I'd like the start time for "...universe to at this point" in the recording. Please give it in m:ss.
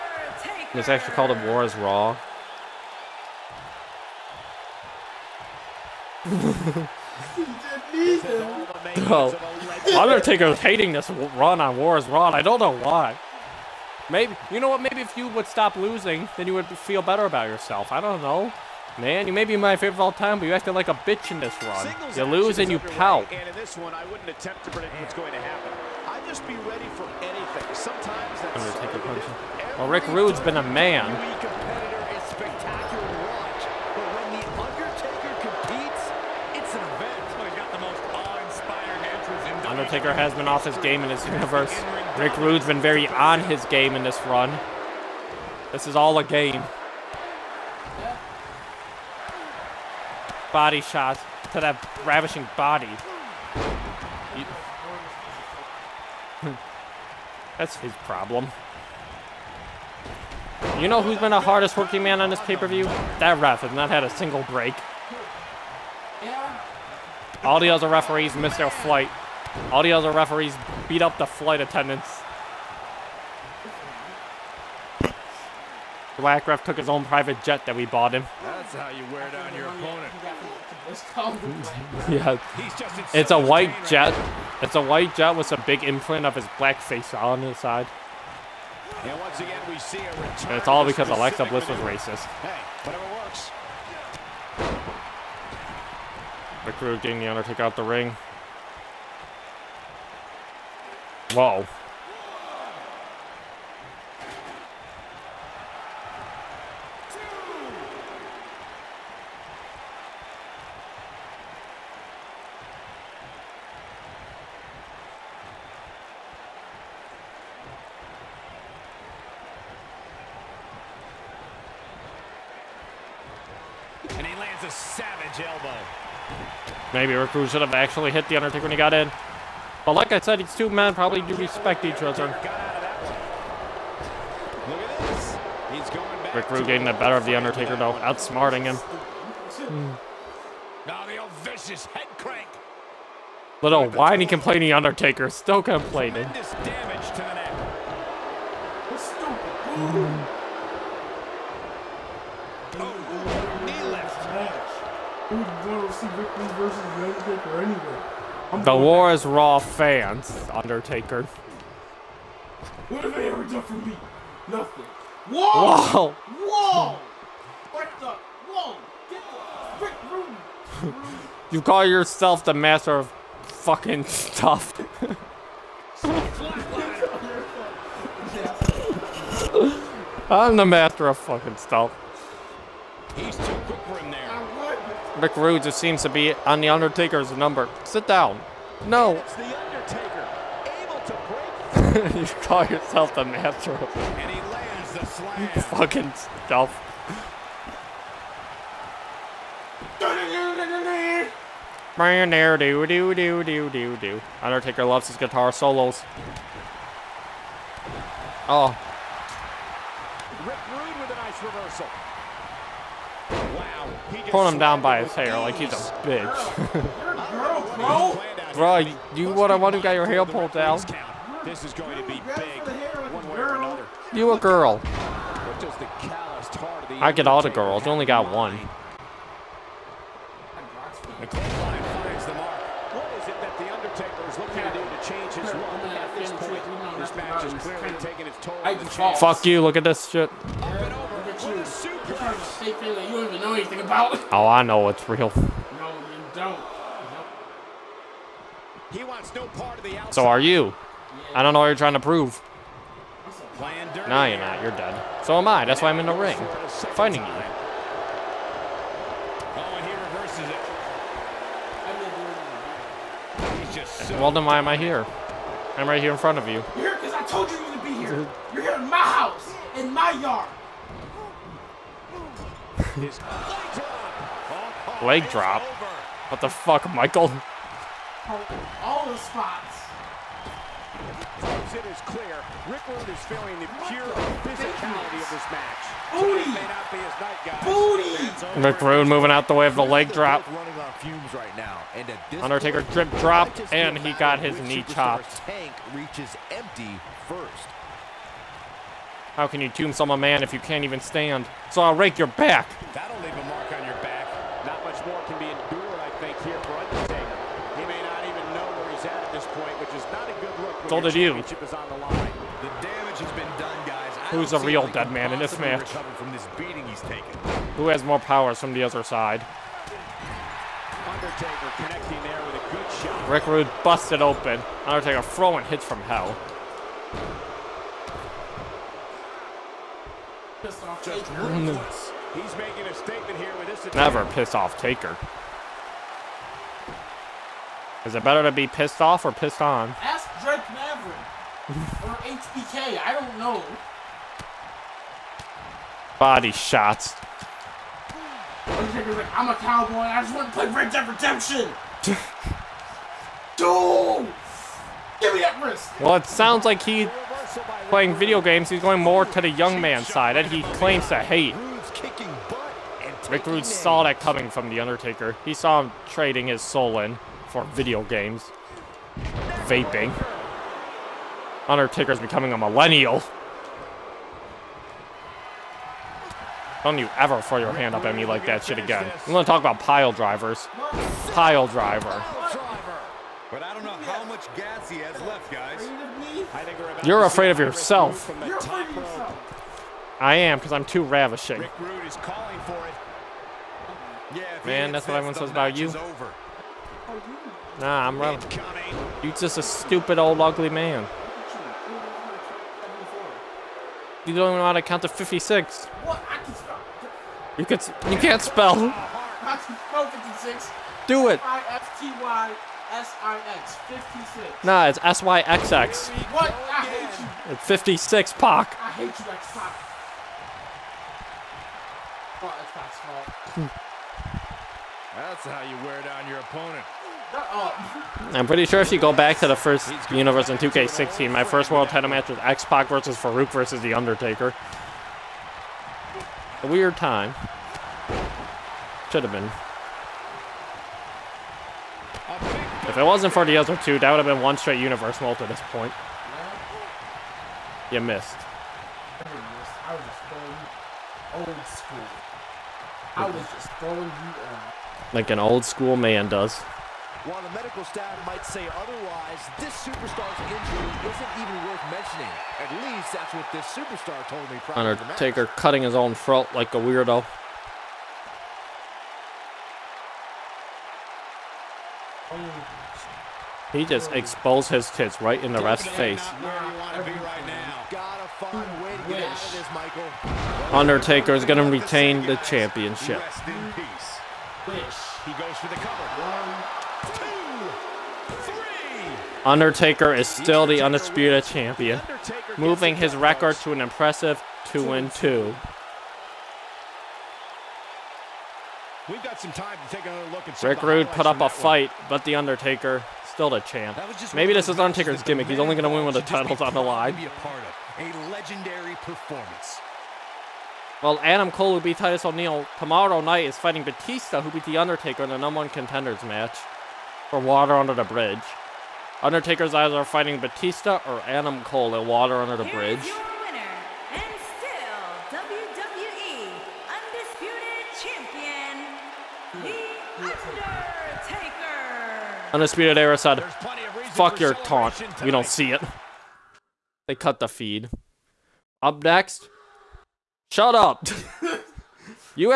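7:24.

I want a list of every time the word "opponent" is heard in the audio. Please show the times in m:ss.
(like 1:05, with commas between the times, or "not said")
1:19, 7:06.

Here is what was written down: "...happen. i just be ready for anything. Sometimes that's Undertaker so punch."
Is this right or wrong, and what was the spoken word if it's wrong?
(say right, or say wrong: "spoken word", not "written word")
right.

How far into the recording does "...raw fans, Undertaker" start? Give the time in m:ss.
2:39.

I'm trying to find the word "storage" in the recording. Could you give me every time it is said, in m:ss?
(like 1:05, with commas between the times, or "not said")
not said.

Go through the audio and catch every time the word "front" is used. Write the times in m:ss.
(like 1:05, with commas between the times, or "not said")
4:26.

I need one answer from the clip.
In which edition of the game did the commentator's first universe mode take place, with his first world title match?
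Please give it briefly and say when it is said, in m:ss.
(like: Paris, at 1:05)
2K16, at 7:10.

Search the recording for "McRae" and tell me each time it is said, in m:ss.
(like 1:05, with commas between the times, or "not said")
3:05.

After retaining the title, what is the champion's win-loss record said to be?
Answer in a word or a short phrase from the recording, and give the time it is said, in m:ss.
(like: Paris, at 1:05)
2 and 2, at 8:14.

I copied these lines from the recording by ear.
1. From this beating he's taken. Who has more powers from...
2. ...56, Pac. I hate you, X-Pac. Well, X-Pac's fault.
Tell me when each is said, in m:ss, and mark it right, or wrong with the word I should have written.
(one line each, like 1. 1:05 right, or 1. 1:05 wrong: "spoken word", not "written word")
1. 5:15 right
2. 6:57 right.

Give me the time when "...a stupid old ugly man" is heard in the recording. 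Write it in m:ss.
6:39.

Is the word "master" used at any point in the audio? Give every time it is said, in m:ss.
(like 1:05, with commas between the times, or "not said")
2:52, 3:00, 3:13.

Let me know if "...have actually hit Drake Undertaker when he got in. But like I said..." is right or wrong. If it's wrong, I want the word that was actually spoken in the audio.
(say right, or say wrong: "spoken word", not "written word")
wrong: "The", not "Drake".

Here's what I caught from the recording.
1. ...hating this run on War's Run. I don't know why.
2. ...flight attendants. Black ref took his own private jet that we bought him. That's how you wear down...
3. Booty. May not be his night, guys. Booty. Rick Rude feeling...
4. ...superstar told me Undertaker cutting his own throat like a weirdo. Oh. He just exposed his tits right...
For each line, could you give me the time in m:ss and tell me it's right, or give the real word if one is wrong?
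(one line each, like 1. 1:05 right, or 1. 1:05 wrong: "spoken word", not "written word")
1. 0:10 right
2. 1:11 right
3. 4:46 wrong: "moving", not "feeling"
4. 7:43 right.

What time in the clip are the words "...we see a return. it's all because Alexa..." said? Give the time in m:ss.
1:29.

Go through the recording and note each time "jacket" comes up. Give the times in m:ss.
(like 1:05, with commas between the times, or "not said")
not said.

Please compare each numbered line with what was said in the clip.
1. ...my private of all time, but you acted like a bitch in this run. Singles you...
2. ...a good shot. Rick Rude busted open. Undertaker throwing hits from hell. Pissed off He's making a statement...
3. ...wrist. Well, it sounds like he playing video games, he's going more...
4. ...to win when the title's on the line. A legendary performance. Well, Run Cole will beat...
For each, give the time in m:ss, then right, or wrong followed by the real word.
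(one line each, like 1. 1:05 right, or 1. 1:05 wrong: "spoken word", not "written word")
1. 0:19 wrong: "favorite", not "private"
2. 5:22 right
3. 5:55 right
4. 8:25 wrong: "Adam", not "Run".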